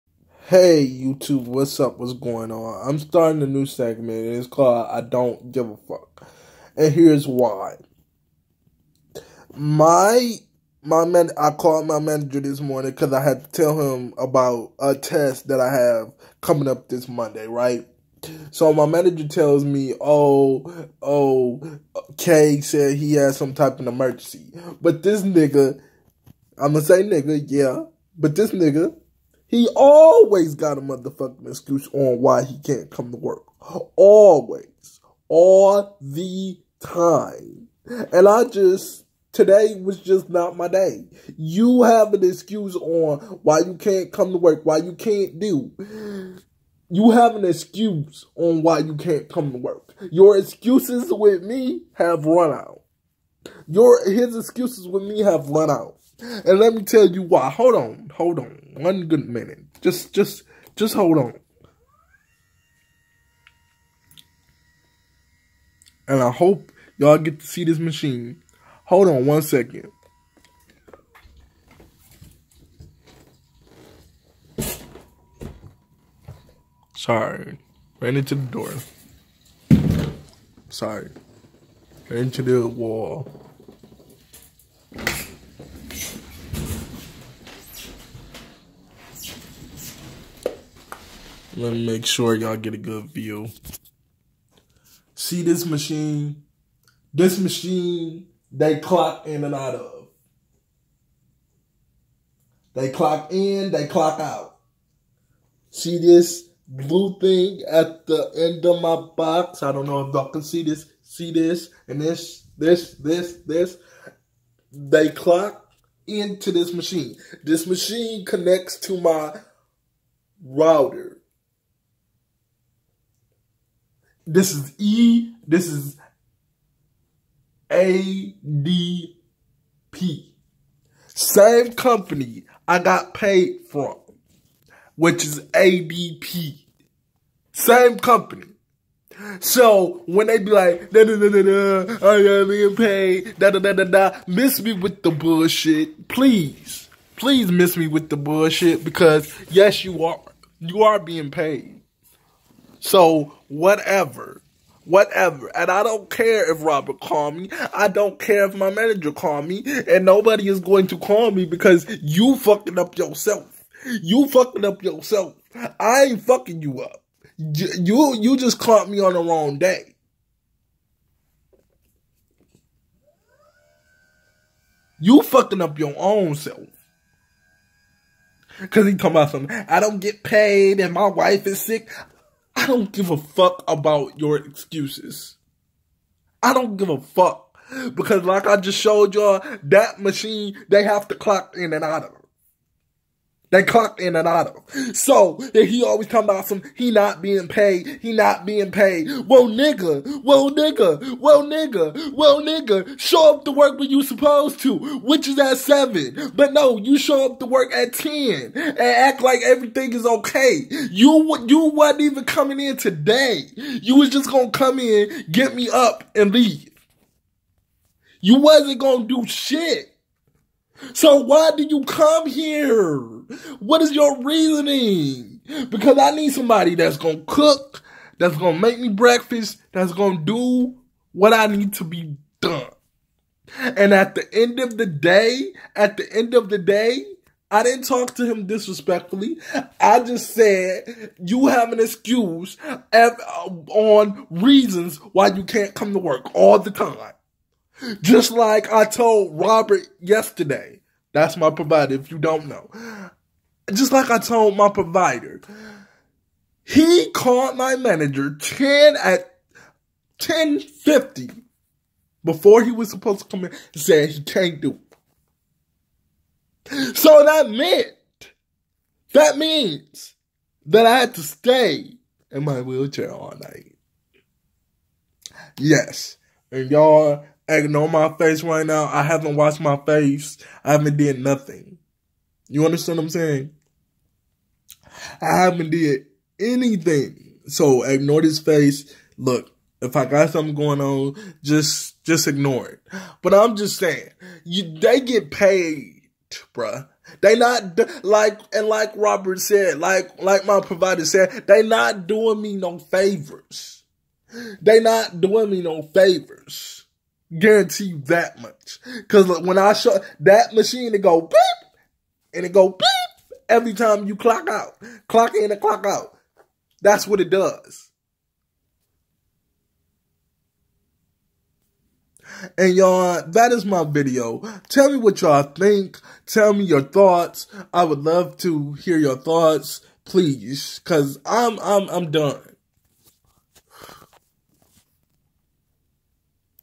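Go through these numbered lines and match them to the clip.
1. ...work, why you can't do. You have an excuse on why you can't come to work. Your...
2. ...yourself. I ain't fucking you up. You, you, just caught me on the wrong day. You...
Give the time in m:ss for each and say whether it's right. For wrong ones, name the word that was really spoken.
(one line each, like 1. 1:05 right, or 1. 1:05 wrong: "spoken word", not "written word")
1. 0:44 right
2. 2:44 right.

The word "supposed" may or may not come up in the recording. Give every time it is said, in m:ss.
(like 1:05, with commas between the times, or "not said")
3:24, 4:22.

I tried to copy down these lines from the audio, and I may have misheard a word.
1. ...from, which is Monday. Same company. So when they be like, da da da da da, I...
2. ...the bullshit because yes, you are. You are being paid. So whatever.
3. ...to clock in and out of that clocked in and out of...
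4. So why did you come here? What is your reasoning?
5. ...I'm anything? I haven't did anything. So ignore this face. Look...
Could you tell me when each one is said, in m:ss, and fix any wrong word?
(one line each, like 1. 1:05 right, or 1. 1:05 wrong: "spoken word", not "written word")
1. 2:13 wrong: "ADP", not "Monday"
2. 2:28 right
3. 3:11 right
4. 3:40 right
5. 4:43 wrong: "saying", not "anything".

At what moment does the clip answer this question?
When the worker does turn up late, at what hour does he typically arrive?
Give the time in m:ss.
3:27.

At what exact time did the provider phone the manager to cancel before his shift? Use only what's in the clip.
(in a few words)
10:50.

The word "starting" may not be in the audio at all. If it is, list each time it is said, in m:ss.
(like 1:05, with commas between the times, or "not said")
0:02.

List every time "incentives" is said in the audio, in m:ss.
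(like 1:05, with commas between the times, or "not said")
not said.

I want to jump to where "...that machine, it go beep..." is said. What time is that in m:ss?
5:10.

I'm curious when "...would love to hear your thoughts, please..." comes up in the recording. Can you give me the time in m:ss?
5:27.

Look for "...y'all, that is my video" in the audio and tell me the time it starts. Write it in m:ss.
5:22.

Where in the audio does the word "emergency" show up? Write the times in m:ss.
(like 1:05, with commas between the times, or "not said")
0:23.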